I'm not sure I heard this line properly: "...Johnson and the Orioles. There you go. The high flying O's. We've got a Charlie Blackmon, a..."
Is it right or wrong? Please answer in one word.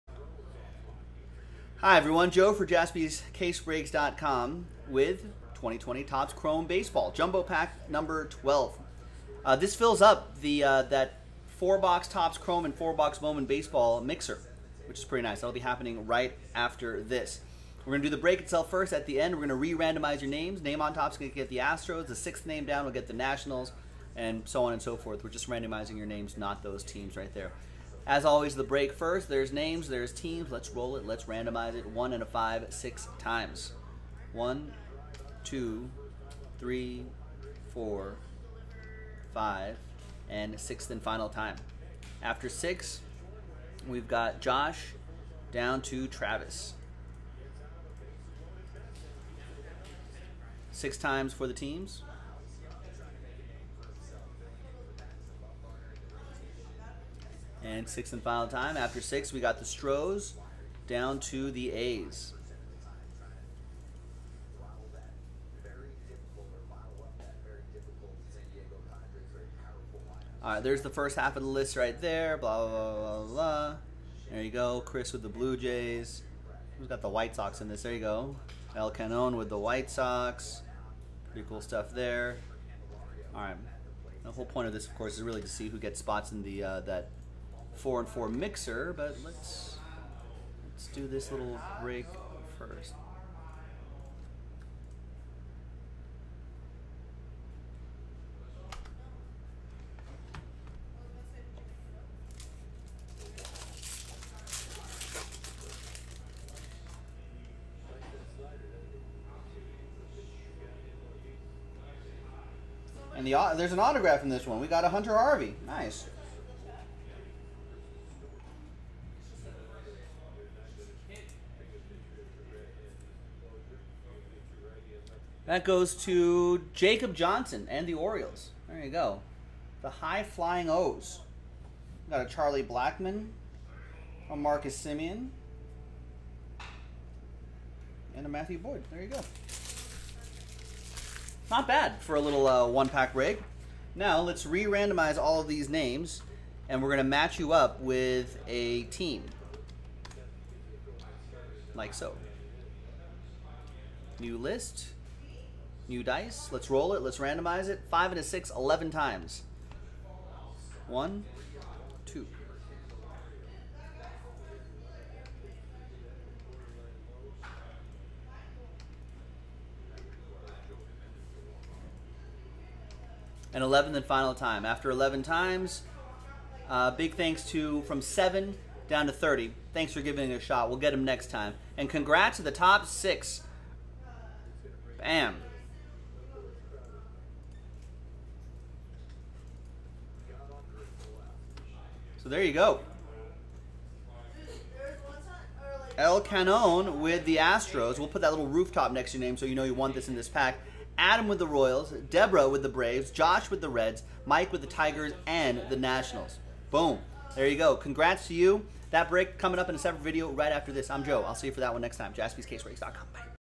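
right.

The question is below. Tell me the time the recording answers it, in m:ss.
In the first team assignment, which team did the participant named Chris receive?
1:15.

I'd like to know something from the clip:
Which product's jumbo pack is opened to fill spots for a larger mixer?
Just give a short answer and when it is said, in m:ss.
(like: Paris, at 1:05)
2020 Topps Chrome Baseball, at 0:05.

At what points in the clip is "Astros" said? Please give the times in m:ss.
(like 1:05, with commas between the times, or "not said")
0:21, 3:17.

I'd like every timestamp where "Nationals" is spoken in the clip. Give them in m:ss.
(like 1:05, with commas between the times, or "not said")
0:23, 3:25.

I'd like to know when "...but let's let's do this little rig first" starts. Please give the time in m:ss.
1:28.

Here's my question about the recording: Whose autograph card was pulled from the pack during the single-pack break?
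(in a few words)
Hunter Harvey.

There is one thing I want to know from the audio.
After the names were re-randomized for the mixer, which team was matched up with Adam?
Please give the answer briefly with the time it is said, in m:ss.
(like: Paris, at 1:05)
Royals, at 3:21.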